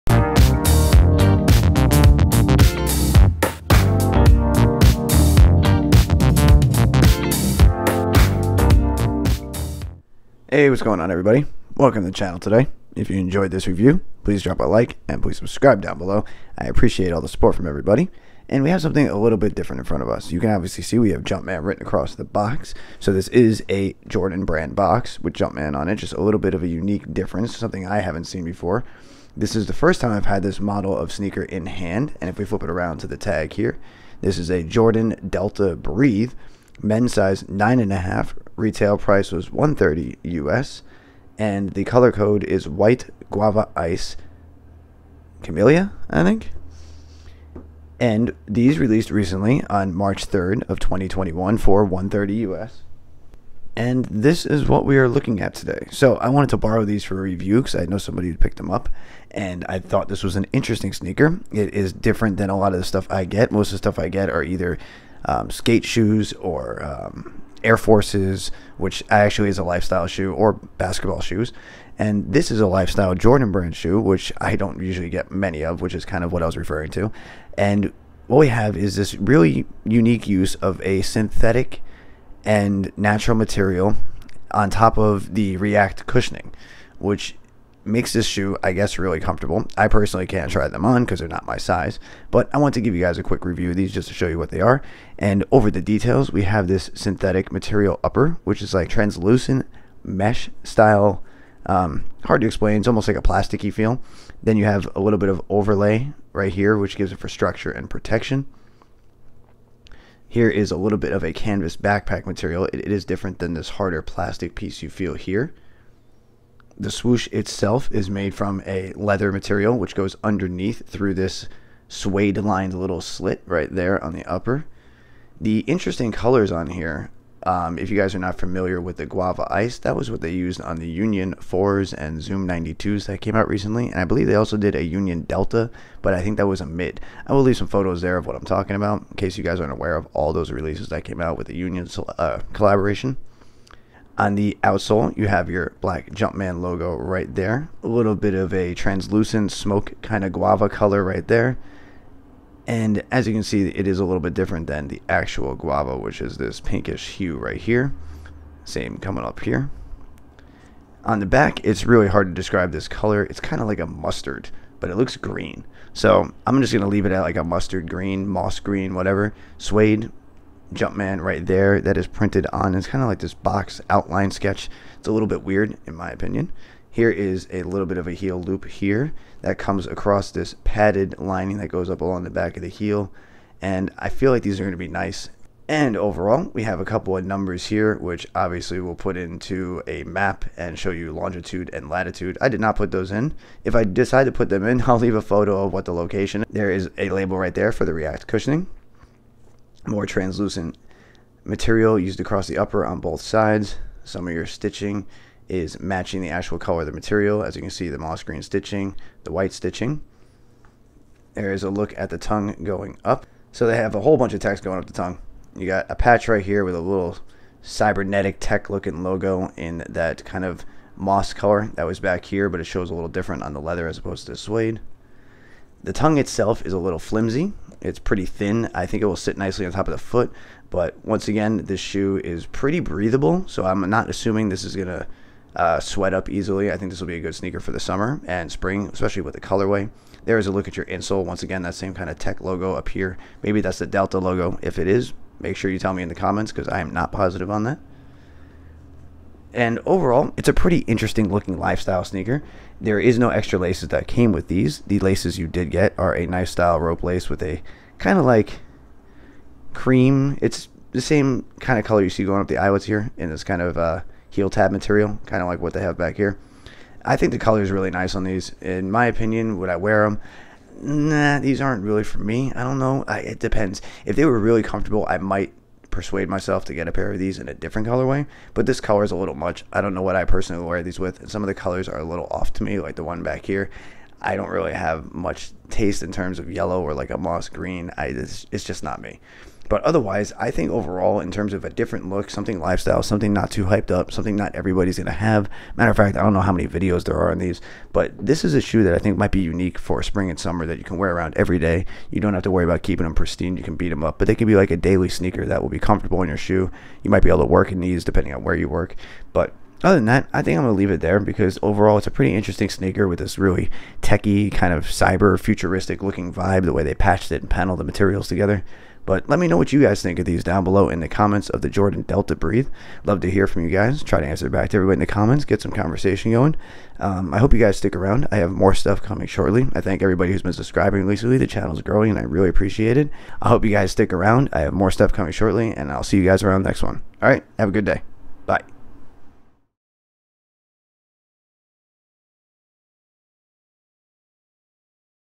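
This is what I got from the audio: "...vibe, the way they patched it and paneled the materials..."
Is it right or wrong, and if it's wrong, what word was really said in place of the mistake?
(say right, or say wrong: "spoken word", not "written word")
right.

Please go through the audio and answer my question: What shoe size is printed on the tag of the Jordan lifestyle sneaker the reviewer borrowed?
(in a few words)
9.5.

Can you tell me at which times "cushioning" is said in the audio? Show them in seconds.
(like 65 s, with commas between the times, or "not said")
86 s, 198 s.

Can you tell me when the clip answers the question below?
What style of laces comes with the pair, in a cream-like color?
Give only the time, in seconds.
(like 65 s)
256 s.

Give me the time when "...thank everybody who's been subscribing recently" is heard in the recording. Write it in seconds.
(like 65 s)
329 s.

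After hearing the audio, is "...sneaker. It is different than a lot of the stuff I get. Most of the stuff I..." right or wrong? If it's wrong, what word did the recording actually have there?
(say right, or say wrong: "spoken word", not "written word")
right.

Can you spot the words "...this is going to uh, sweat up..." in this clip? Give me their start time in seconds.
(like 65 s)
234 s.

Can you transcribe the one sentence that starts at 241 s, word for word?
Once again, that same kind of tech logo up here.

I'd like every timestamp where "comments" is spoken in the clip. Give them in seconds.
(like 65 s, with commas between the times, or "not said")
246 s, 321 s, 325 s.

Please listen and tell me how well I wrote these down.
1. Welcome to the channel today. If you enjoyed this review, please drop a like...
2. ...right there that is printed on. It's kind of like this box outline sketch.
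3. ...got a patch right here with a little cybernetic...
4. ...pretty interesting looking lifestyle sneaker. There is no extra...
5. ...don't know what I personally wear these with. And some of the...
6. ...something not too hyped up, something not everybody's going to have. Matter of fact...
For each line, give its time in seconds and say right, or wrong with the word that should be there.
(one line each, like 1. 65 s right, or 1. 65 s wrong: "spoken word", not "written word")
1. 11 s right
2. 171 s right
3. 215 s right
4. 250 s right
5. 279 s right
6. 293 s right.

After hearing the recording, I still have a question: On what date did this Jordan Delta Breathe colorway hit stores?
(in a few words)
March 3rd, 2021.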